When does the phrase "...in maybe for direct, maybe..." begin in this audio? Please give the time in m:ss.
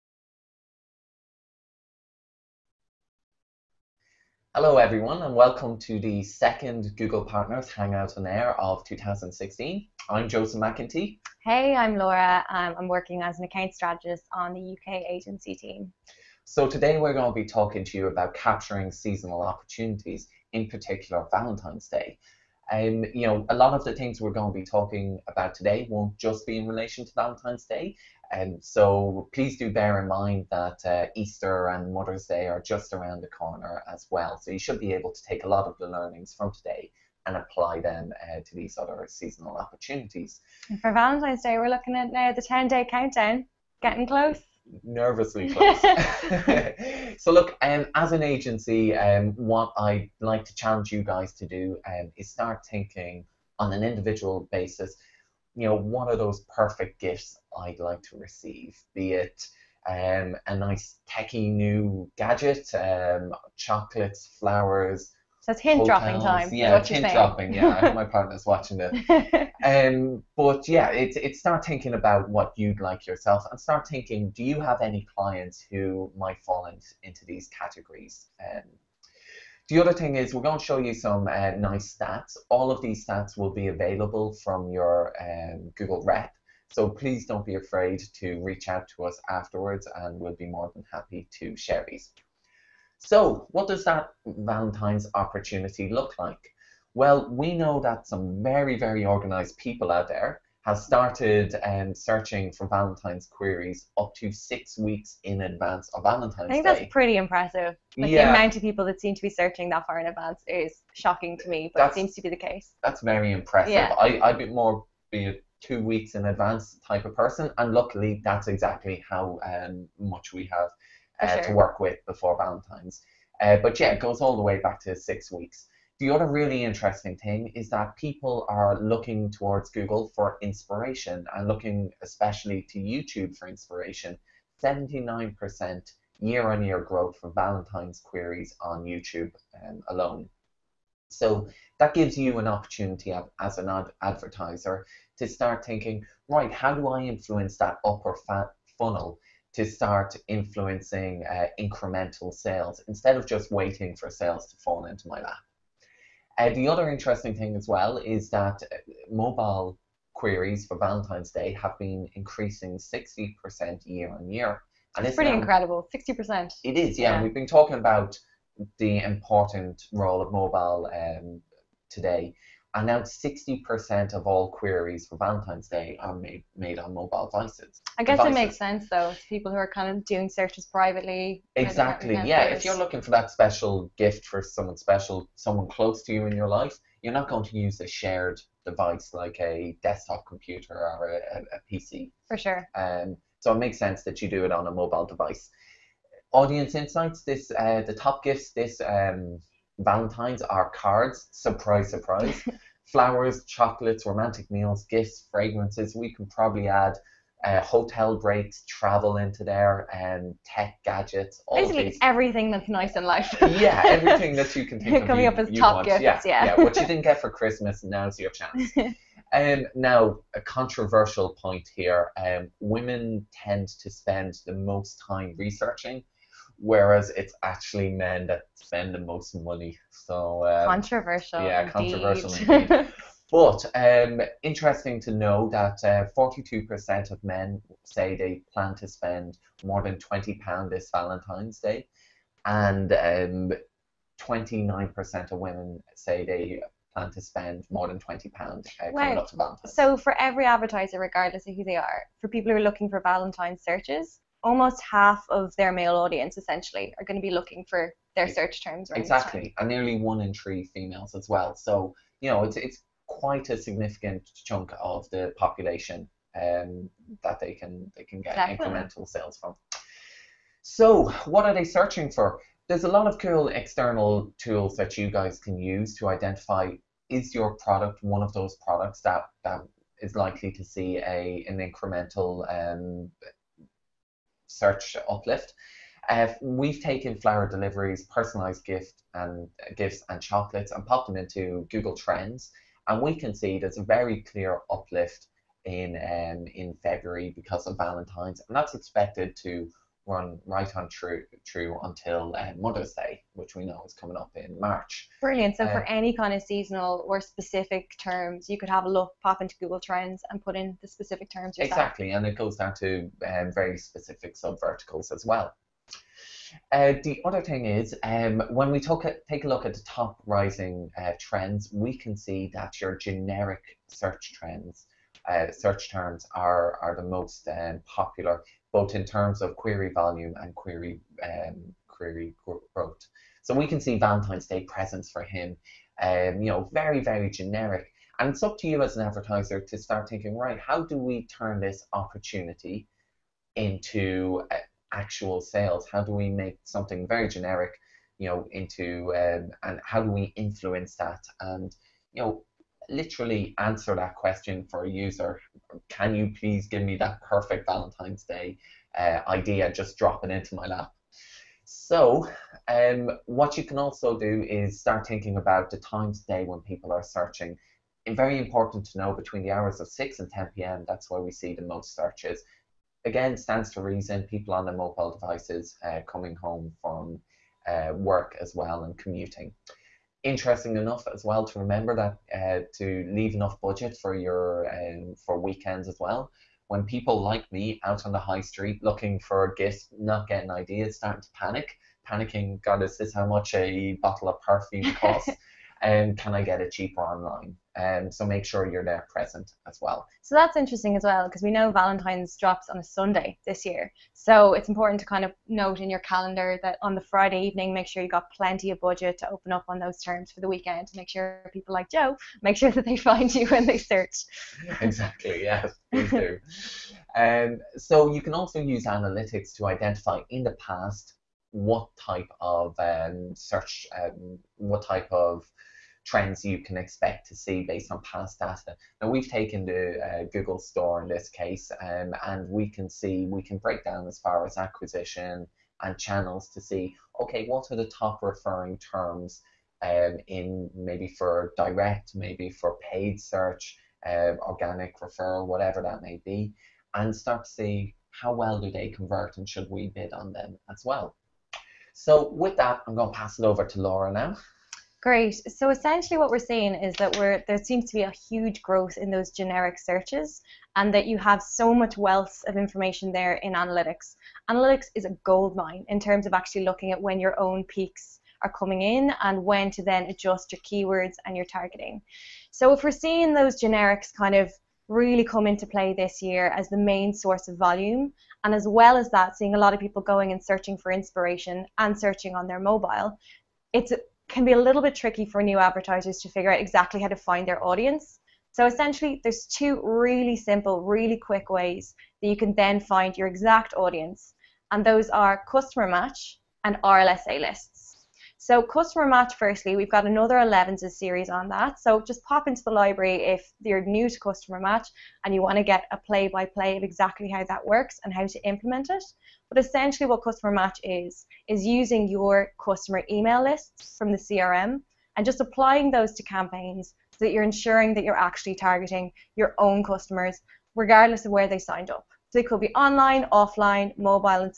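7:20.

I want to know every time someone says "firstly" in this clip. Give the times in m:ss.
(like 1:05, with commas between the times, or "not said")
8:19.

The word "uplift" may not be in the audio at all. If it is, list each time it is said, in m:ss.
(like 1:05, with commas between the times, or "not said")
4:45, 4:54.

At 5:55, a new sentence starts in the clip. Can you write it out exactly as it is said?
Can you please give me that perfect Valentine's Day uh, idea just dropping into my lap?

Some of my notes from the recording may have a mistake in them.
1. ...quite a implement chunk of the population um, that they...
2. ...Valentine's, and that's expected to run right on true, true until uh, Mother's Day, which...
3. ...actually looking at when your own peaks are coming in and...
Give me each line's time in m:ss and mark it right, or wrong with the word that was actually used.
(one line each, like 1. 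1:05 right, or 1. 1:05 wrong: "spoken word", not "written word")
1. 4:23 wrong: "significant", not "implement"
2. 4:57 right
3. 7:46 right.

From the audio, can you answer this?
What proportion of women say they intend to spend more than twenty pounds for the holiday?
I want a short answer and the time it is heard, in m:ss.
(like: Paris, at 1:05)
29%, at 4:04.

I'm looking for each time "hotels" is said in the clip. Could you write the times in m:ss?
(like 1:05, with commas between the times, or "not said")
1:05, 3:27.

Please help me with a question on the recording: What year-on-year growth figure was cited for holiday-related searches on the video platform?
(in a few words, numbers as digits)
79%.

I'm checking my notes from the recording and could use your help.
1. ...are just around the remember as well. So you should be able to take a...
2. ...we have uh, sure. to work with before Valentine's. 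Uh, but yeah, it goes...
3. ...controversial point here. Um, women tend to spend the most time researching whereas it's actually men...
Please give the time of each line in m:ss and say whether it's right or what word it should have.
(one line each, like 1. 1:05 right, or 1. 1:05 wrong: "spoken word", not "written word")
1. 0:32 wrong: "corner", not "remember"
2. 2:00 right
3. 3:40 right.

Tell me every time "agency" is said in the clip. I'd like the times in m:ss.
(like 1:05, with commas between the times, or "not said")
0:15, 0:48.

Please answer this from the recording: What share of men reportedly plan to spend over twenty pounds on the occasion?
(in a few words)
42%.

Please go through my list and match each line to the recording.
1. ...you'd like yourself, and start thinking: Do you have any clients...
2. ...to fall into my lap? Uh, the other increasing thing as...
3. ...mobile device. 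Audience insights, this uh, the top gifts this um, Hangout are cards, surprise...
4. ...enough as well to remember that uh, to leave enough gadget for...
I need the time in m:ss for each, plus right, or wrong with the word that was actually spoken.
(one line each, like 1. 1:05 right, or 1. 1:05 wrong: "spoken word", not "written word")
1. 1:12 right
2. 2:34 wrong: "interesting", not "increasing"
3. 3:14 wrong: "Valentines", not "Hangout"
4. 6:20 wrong: "budget", not "gadget".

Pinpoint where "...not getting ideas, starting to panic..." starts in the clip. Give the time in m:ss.
6:29.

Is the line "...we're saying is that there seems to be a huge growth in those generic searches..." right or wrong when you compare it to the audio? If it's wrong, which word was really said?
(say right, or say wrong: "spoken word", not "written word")
right.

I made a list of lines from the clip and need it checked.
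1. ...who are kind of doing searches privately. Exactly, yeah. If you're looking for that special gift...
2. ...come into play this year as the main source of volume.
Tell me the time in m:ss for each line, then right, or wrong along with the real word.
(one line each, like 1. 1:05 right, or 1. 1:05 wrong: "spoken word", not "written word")
1. 2:59 right
2. 7:55 right.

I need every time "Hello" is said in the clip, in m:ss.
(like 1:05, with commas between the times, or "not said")
0:04.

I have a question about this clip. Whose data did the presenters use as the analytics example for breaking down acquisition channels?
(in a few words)
Google Store.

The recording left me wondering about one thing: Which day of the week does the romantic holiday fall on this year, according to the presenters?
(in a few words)
Sunday.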